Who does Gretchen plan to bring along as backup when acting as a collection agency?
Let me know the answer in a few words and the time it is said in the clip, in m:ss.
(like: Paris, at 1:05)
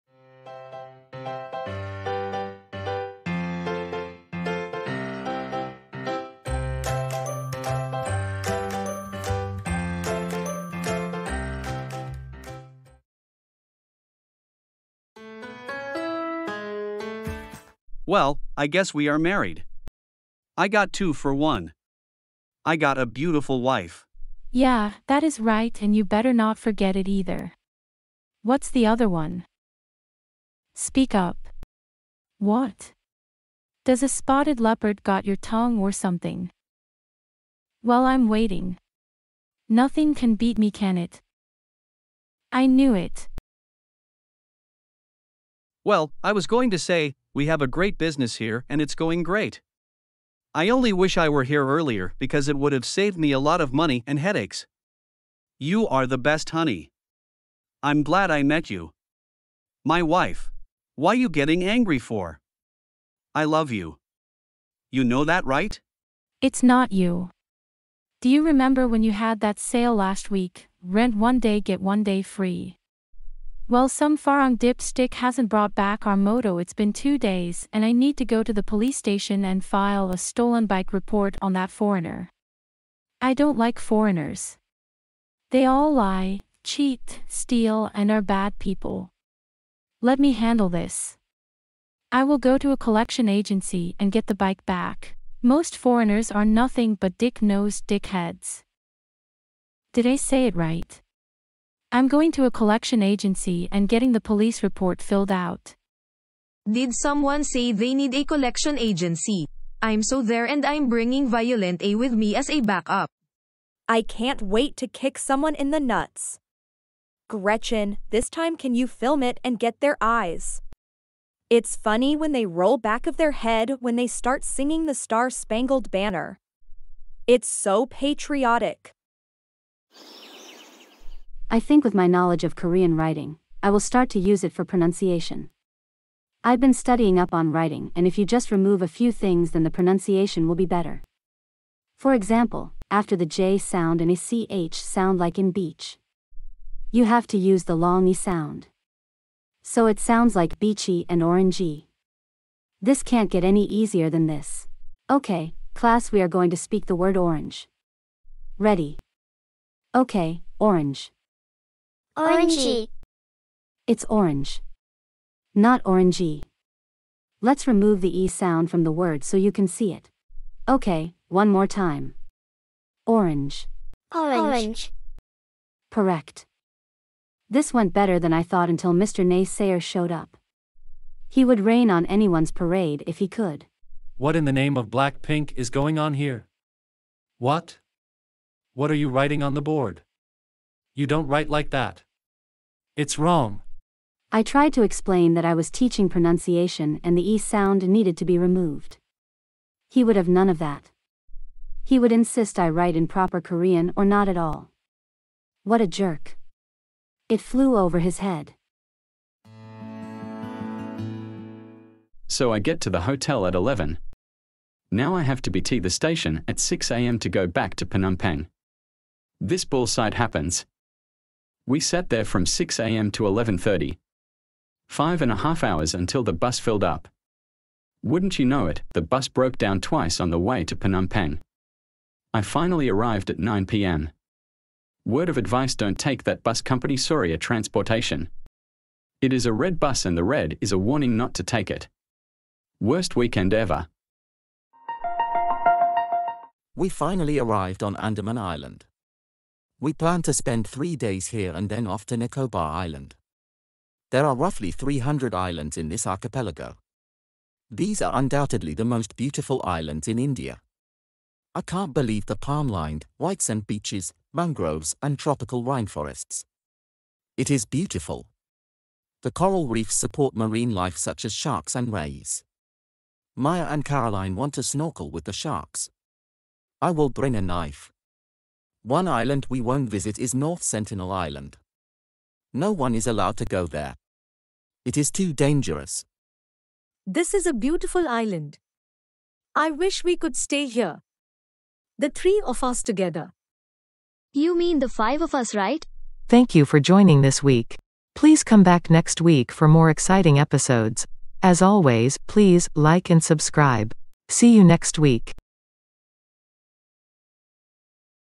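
Violent A, at 1:51.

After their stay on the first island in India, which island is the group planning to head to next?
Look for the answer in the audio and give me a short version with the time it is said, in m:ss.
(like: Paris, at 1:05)
Nicobar Island, at 4:12.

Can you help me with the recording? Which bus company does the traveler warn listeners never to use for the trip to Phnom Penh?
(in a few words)
Soria Transportation.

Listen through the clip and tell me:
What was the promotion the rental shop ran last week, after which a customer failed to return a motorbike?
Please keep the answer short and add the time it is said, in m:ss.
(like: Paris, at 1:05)
Rent one day, get one day free, at 1:10.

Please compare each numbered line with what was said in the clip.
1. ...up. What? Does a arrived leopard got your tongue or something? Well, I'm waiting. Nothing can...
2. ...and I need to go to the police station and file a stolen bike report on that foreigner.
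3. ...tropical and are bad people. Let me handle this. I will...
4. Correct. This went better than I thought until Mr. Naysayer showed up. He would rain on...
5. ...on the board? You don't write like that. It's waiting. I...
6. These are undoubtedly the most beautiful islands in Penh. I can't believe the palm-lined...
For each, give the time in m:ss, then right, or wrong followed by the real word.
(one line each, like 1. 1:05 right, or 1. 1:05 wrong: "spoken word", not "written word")
1. 0:31 wrong: "spotted", not "arrived"
2. 1:17 right
3. 1:27 wrong: "steal", not "tropical"
4. 2:55 right
5. 3:09 wrong: "wrong", not "waiting"
6. 4:17 wrong: "India", not "Penh".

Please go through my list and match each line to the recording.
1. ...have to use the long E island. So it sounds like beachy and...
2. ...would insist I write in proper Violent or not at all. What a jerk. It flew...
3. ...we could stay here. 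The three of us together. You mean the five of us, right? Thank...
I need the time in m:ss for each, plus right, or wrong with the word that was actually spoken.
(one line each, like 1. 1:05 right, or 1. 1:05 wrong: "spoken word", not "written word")
1. 2:27 wrong: "sound", not "island"
2. 3:21 wrong: "Korean", not "Violent"
3. 4:50 right.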